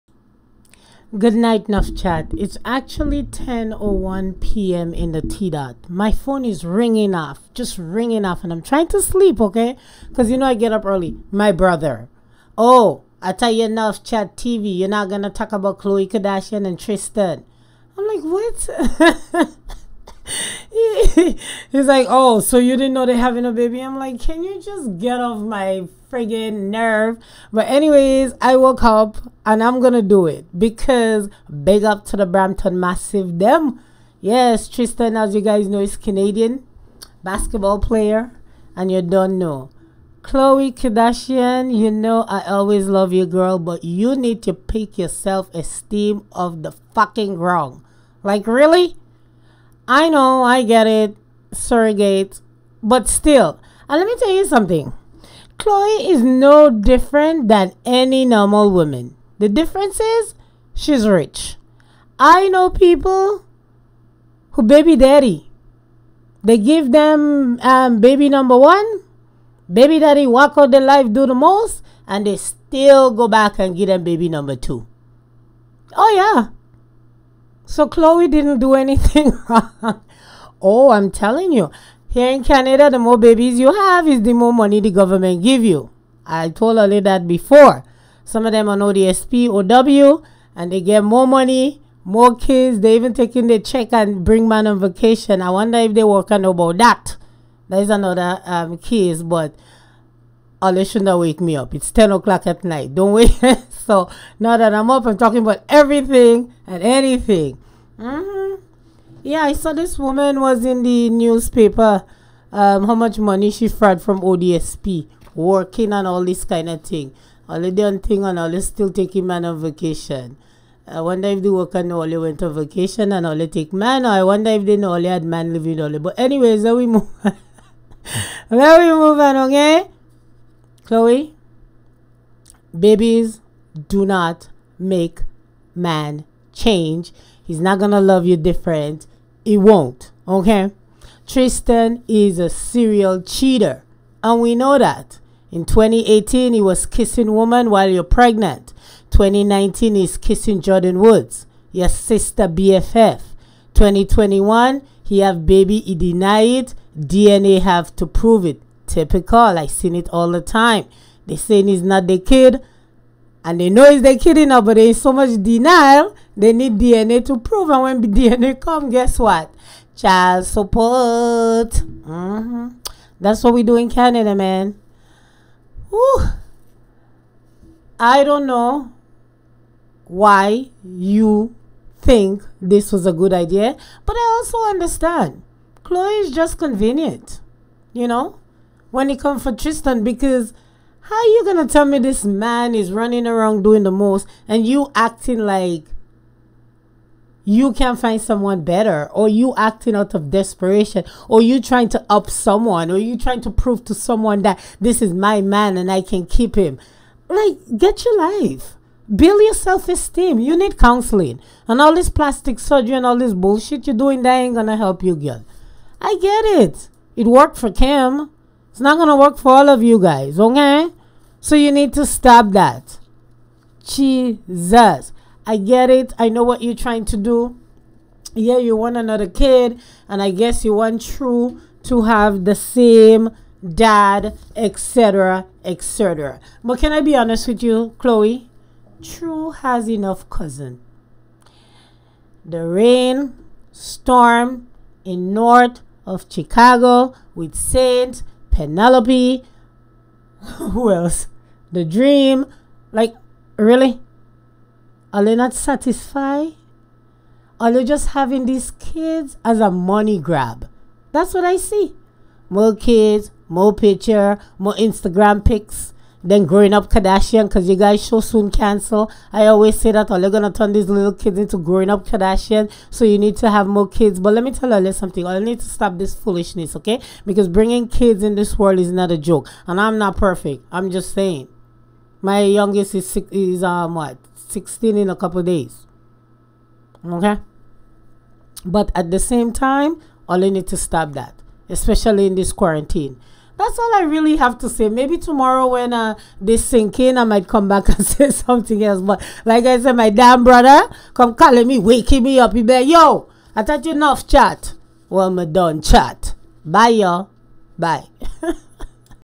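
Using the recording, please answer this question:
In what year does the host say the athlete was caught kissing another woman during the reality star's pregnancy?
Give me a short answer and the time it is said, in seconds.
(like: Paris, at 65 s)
2018, at 145 s.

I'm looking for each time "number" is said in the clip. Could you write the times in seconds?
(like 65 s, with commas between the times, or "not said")
68 s, 74 s.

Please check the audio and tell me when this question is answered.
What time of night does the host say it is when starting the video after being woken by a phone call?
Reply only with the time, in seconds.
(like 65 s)
3 s.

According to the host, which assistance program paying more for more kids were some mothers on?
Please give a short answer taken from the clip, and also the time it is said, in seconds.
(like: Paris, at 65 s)
OW, at 88 s.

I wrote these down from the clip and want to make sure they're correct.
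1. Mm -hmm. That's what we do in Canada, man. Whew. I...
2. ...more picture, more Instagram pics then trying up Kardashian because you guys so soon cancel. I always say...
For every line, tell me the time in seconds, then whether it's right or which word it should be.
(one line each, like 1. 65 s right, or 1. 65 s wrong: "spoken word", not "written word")
1. 171 s right
2. 263 s wrong: "growing", not "trying".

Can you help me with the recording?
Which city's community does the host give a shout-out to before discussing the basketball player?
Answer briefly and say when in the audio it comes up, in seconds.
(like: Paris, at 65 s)
Brampton, at 32 s.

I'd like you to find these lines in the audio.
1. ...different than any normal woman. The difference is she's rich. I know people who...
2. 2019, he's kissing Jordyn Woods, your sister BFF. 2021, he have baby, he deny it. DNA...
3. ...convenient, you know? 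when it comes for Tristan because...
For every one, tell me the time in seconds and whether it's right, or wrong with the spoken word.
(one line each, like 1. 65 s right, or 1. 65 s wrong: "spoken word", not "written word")
1. 56 s right
2. 149 s right
3. 186 s right.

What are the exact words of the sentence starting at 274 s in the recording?
But let me tell you something, I need to stop this foolishness, okay?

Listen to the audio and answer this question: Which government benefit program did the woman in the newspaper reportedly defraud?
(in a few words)
ODSP.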